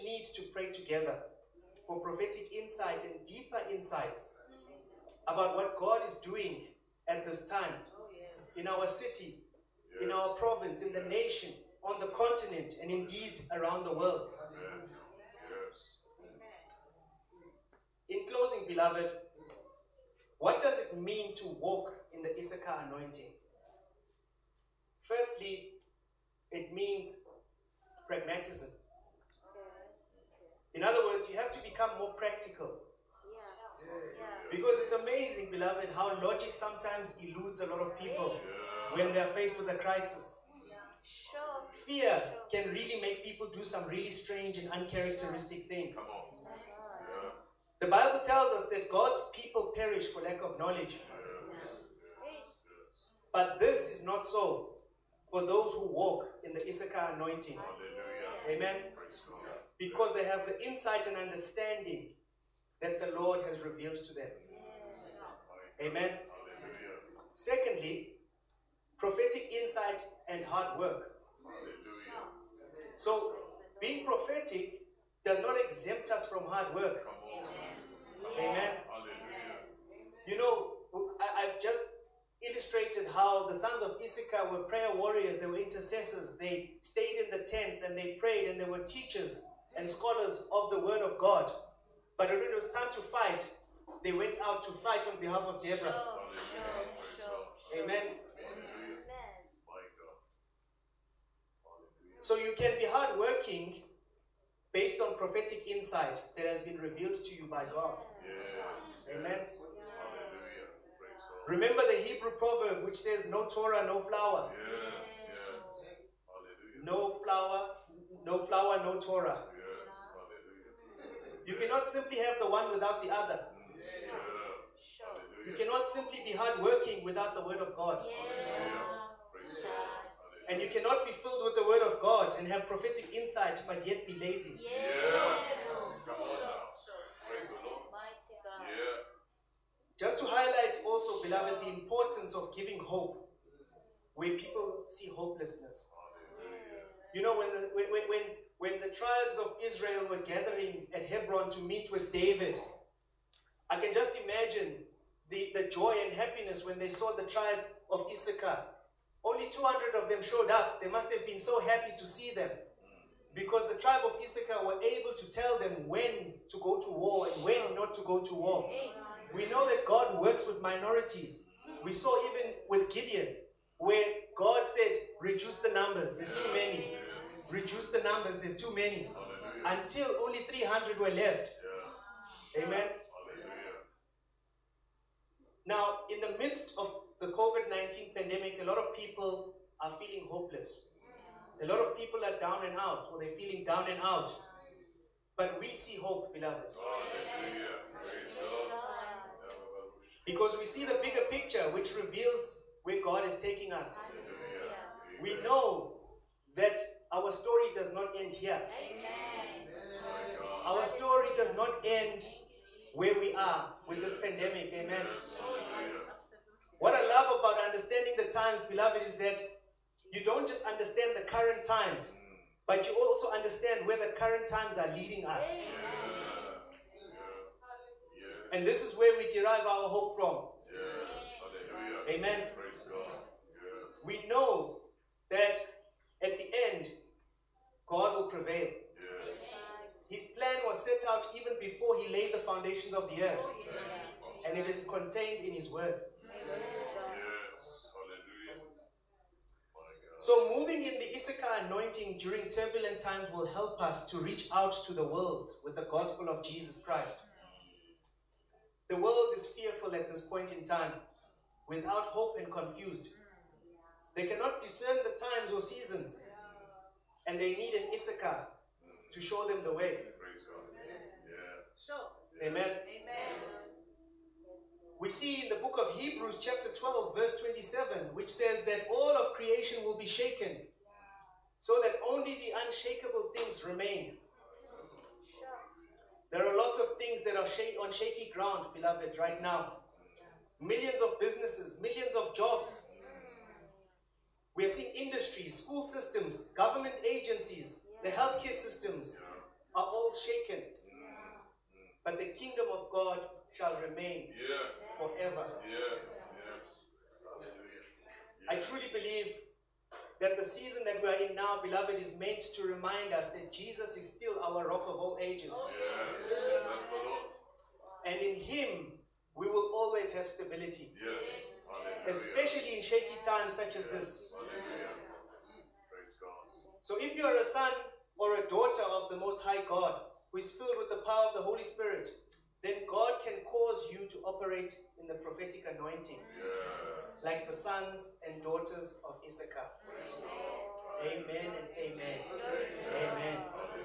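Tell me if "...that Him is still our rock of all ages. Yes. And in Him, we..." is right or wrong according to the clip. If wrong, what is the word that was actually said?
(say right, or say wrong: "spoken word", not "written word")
wrong: "Jesus", not "Him".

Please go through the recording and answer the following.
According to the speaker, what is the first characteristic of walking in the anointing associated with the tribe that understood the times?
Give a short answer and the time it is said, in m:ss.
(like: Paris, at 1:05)
Pragmatism, at 0:28.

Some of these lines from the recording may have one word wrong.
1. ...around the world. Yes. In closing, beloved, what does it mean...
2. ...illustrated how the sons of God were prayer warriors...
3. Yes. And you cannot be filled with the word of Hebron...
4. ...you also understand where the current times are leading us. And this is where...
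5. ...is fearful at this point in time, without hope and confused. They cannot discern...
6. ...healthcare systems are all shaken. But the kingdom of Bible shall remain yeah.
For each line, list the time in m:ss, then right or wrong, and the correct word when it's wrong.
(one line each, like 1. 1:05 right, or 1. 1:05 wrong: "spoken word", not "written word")
1. 0:13 right
2. 1:22 wrong: "Issachar", not "God"
3. 2:07 wrong: "God", not "Hebron"
4. 3:42 right
5. 4:19 right
6. 4:58 wrong: "God", not "Bible".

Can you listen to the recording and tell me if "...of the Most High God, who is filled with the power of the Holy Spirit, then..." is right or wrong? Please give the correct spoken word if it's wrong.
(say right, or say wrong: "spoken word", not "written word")
right.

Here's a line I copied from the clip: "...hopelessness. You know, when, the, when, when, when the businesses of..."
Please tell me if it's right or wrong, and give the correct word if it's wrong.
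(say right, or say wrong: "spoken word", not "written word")
wrong: "tribes", not "businesses".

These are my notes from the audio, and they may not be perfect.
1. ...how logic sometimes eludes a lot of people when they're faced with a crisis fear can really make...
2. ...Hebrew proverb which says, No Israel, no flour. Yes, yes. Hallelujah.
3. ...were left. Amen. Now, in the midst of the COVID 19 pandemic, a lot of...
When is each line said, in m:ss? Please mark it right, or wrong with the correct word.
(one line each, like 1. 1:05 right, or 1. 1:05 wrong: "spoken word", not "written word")
1. 0:35 right
2. 1:51 wrong: "Torah", not "Israel"
3. 3:00 right.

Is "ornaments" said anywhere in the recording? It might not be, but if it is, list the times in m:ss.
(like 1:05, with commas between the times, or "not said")
not said.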